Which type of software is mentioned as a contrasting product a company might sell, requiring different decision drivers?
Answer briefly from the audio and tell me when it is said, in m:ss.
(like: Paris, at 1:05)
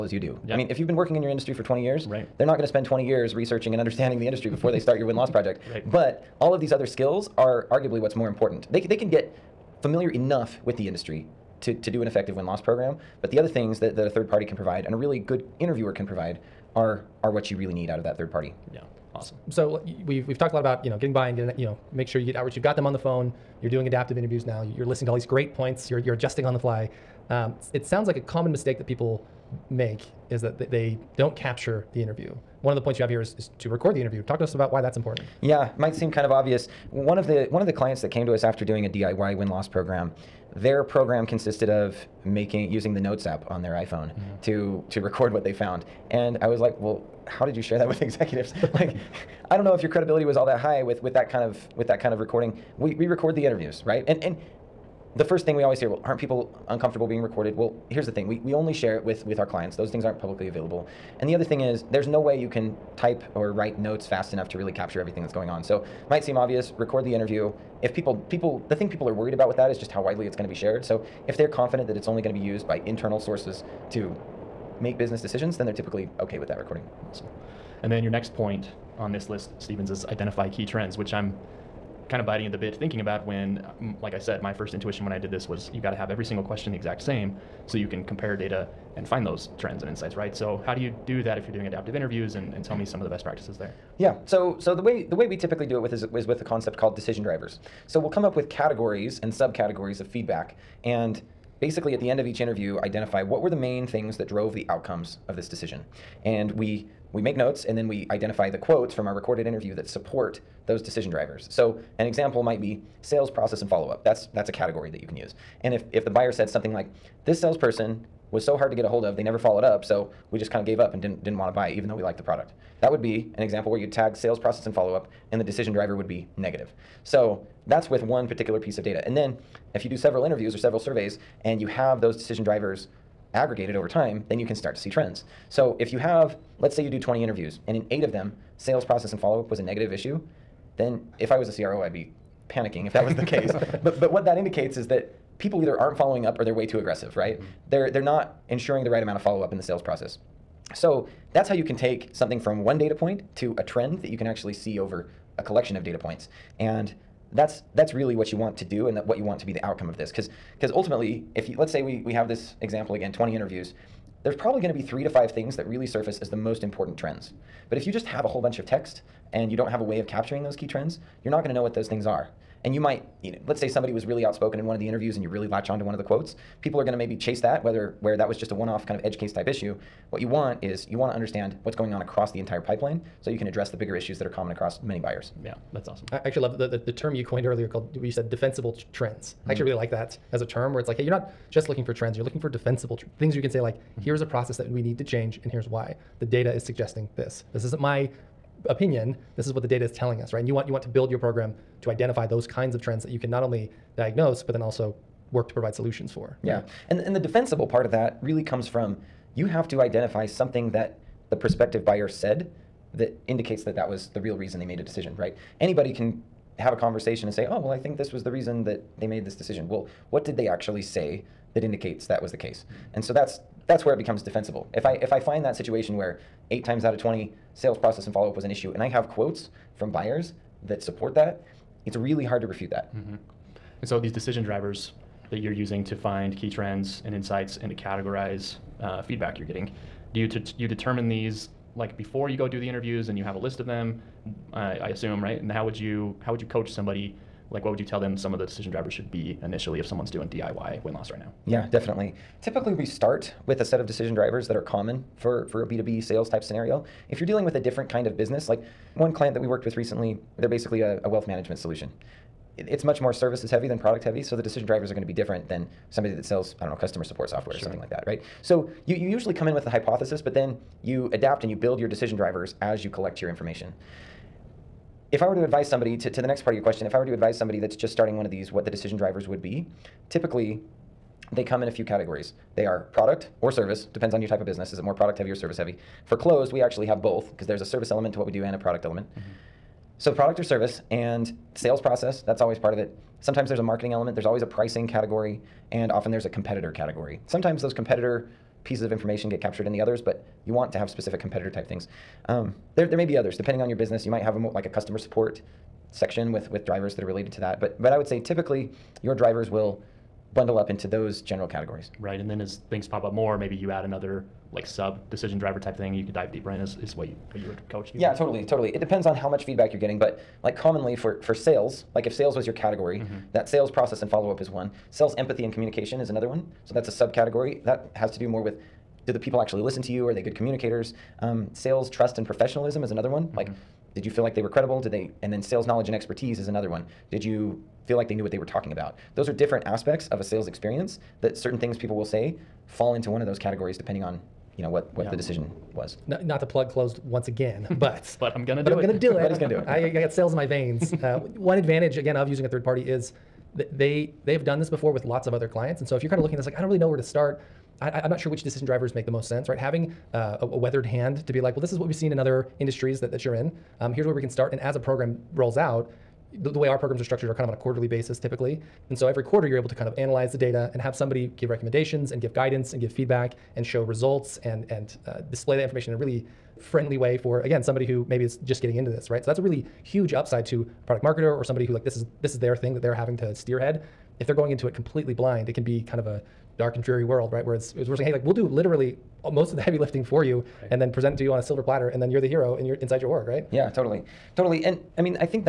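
customer support software, at 4:26.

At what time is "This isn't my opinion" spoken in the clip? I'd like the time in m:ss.
3:17.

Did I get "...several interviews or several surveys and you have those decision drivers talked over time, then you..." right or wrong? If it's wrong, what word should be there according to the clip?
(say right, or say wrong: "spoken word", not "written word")
wrong: "aggregated", not "talked".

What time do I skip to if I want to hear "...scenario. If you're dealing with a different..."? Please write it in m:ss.
4:16.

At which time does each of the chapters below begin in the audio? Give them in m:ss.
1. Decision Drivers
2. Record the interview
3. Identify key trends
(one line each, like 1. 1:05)
1. 3:52
2. 0:18
3. 1:16.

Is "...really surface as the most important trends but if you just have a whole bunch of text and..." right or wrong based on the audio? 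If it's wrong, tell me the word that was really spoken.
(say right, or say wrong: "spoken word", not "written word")
right.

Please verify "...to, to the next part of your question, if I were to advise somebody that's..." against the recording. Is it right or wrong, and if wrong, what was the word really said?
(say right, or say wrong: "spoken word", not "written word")
right.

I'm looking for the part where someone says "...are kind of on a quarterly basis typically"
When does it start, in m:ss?
6:07.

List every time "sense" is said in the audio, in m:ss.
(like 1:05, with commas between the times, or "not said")
5:59.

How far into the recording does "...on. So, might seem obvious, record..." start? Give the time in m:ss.
1:05.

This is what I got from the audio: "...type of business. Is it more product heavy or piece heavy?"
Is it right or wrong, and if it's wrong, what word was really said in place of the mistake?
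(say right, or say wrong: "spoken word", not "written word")
wrong: "service", not "piece".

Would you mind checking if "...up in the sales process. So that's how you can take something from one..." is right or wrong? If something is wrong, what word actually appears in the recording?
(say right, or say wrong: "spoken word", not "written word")
right.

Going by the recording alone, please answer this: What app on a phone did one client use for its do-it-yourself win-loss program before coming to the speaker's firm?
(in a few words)
Notes app.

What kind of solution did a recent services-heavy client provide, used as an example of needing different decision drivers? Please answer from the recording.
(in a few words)
wealth management.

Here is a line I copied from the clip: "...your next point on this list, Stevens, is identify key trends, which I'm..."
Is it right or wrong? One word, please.
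right.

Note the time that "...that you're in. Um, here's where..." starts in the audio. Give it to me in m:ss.
6:03.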